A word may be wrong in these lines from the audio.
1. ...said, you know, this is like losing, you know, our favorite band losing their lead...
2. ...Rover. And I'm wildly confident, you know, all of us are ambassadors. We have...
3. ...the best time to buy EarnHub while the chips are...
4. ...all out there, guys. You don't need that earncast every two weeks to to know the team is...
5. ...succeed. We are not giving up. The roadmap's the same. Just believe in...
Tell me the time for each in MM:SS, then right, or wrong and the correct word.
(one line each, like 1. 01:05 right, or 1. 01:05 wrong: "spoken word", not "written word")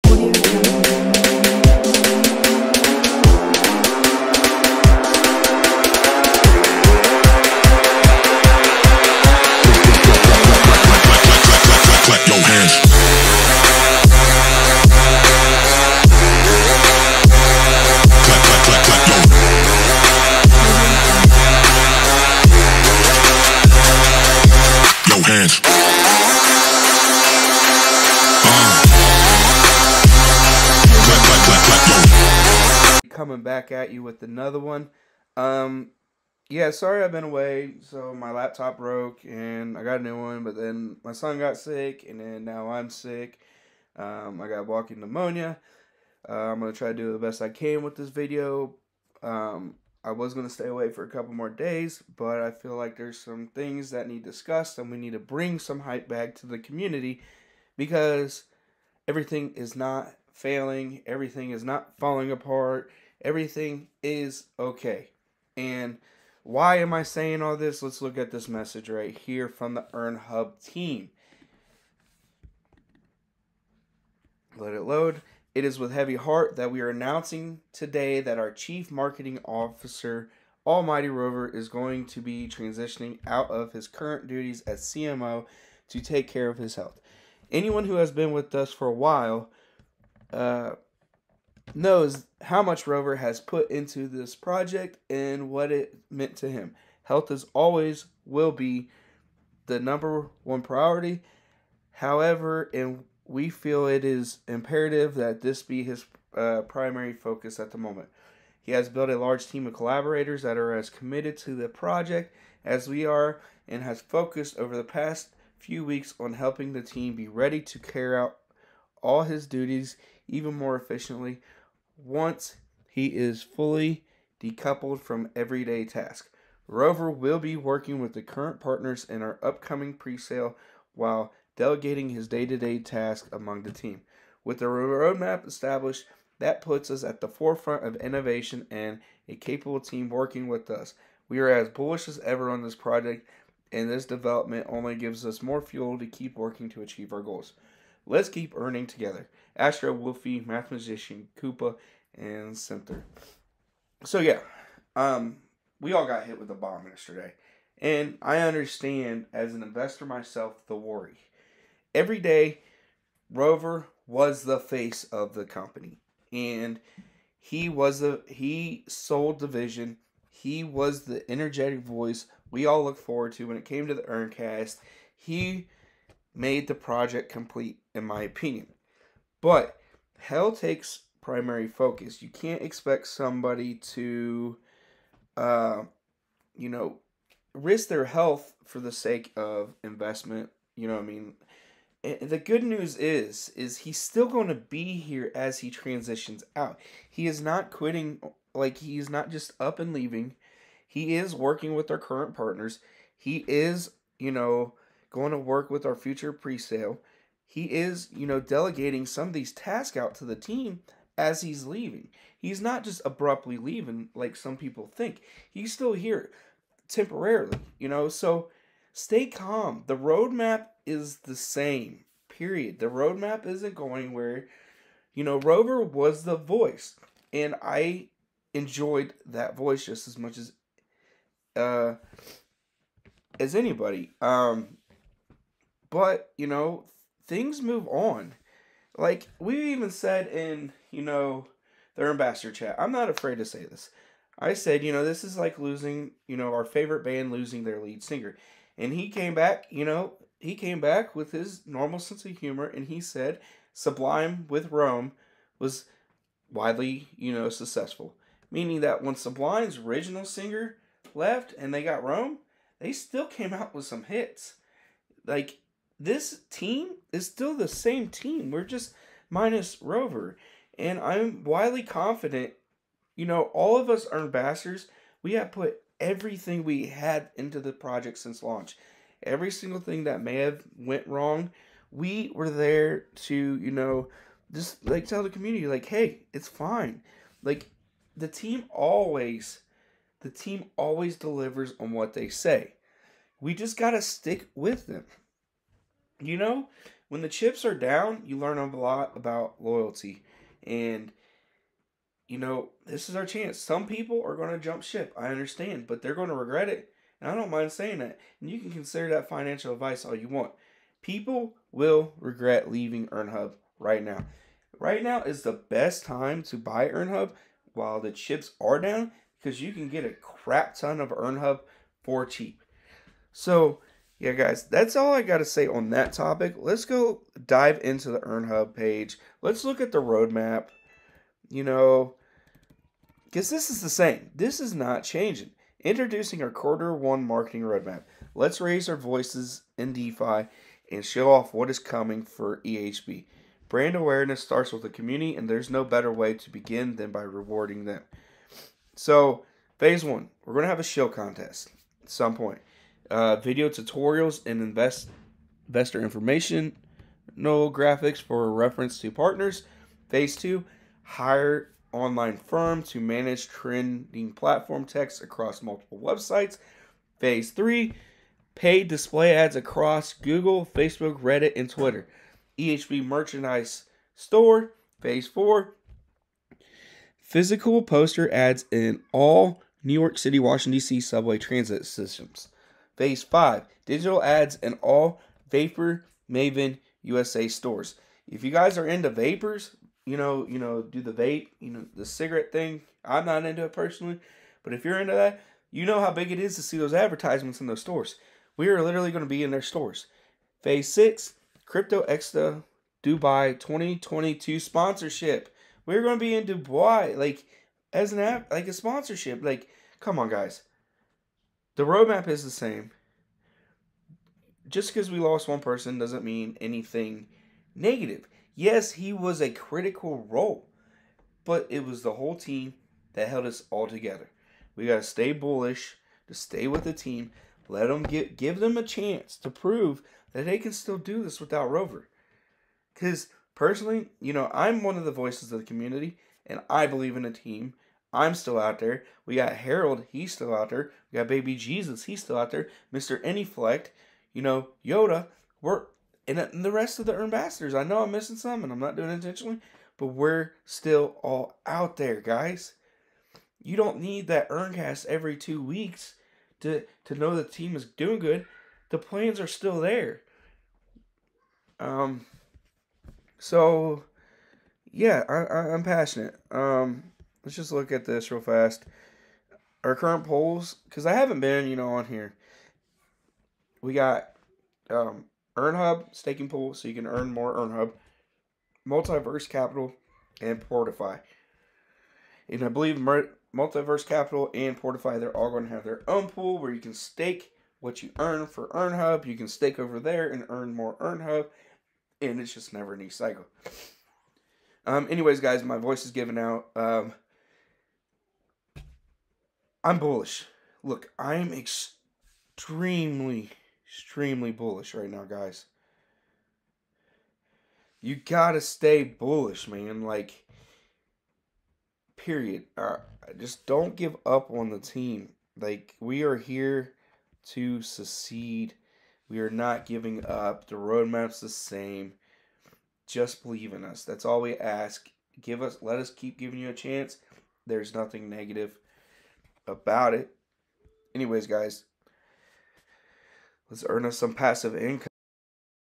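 1. 04:04 right
2. 04:29 right
3. 05:15 right
4. 07:31 right
5. 08:37 right.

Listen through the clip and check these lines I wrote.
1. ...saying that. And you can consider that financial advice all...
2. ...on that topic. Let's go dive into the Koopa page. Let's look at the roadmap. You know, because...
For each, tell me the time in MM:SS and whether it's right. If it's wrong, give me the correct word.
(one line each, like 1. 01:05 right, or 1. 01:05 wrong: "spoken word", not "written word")
1. 05:07 right
2. 05:25 wrong: "EarnHub", not "Koopa".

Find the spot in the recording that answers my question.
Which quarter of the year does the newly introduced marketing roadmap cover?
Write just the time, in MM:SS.
05:36.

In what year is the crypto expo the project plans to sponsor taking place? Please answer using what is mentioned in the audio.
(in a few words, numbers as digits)
2022.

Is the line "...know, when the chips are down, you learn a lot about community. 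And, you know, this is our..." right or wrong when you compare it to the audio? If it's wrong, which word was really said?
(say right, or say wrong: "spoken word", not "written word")
wrong: "loyalty", not "community".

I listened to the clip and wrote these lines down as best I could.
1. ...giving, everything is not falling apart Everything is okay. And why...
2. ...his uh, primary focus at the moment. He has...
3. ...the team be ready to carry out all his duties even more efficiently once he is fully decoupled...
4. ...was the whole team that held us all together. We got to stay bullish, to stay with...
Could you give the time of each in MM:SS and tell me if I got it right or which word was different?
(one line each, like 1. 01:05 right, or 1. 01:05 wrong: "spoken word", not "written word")
1. 01:00 wrong: "failing", not "giving"
2. 01:45 right
3. 01:56 right
4. 07:01 right.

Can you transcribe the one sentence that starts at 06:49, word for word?
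Like, come on, guys the roadmap is the same.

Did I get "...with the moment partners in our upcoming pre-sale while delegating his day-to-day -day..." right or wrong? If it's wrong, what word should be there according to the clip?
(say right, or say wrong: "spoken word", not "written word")
wrong: "current", not "moment".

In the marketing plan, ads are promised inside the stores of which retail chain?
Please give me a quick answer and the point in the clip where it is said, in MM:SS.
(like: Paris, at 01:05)
Vapor Maven USA, at 06:25.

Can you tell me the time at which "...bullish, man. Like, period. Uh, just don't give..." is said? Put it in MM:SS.
08:29.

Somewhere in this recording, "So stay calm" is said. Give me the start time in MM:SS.
03:38.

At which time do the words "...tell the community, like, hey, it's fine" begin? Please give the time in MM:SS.
04:45.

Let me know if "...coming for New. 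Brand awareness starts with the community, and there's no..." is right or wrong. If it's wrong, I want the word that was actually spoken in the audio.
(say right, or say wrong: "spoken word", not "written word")
wrong: "EHB", not "New".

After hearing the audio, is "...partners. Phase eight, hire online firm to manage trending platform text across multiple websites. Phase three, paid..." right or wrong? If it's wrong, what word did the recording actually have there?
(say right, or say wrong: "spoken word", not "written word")
wrong: "two", not "eight".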